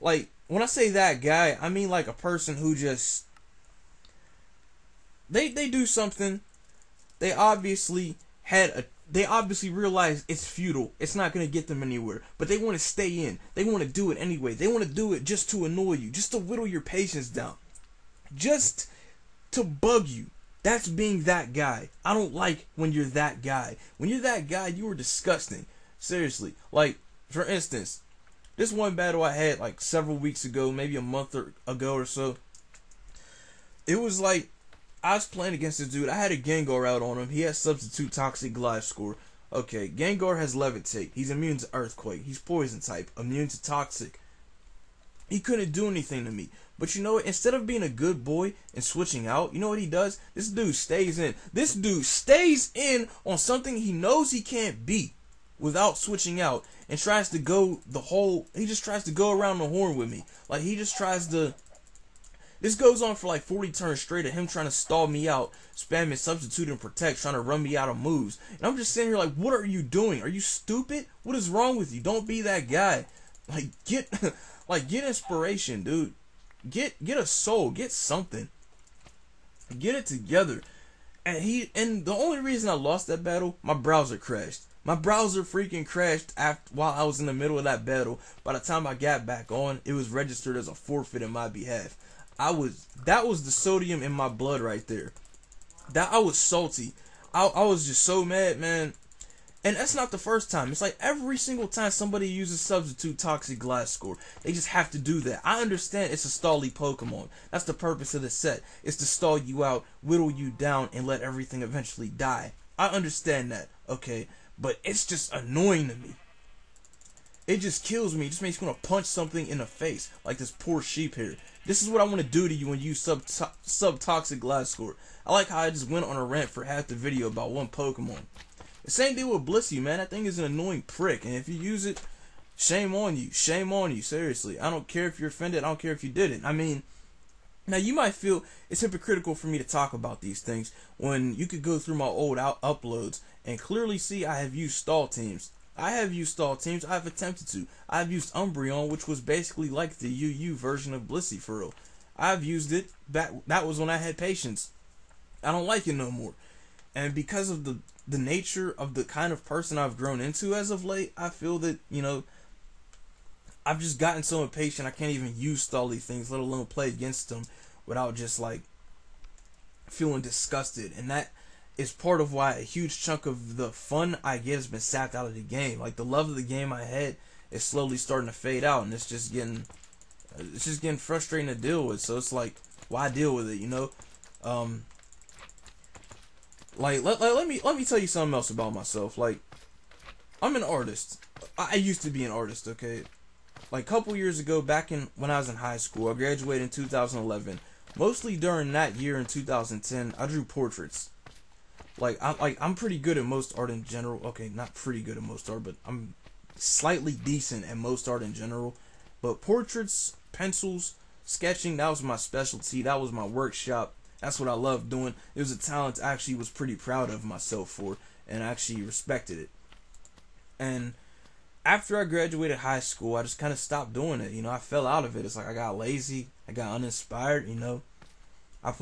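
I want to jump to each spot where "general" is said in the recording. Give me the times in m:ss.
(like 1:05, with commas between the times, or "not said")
3:23, 3:28.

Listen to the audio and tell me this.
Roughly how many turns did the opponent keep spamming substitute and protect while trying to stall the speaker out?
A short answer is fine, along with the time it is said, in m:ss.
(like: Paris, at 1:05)
40, at 1:03.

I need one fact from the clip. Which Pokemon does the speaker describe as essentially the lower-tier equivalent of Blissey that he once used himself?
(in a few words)
Umbreon.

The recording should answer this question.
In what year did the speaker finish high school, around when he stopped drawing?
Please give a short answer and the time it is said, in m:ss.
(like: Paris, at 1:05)
2011, at 3:16.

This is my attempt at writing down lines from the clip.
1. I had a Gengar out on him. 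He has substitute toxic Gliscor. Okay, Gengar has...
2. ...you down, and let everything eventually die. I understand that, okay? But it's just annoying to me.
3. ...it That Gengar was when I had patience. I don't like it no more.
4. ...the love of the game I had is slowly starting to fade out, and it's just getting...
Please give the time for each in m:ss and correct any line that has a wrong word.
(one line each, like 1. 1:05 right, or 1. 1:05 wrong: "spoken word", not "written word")
1. 0:36 right
2. 1:50 right
3. 2:32 wrong: "That", not "Gengar"
4. 2:55 right.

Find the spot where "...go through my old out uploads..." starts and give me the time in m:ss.
2:21.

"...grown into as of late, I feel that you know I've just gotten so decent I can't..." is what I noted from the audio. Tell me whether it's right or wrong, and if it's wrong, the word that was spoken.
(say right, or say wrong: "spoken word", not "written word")
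wrong: "impatient", not "decent".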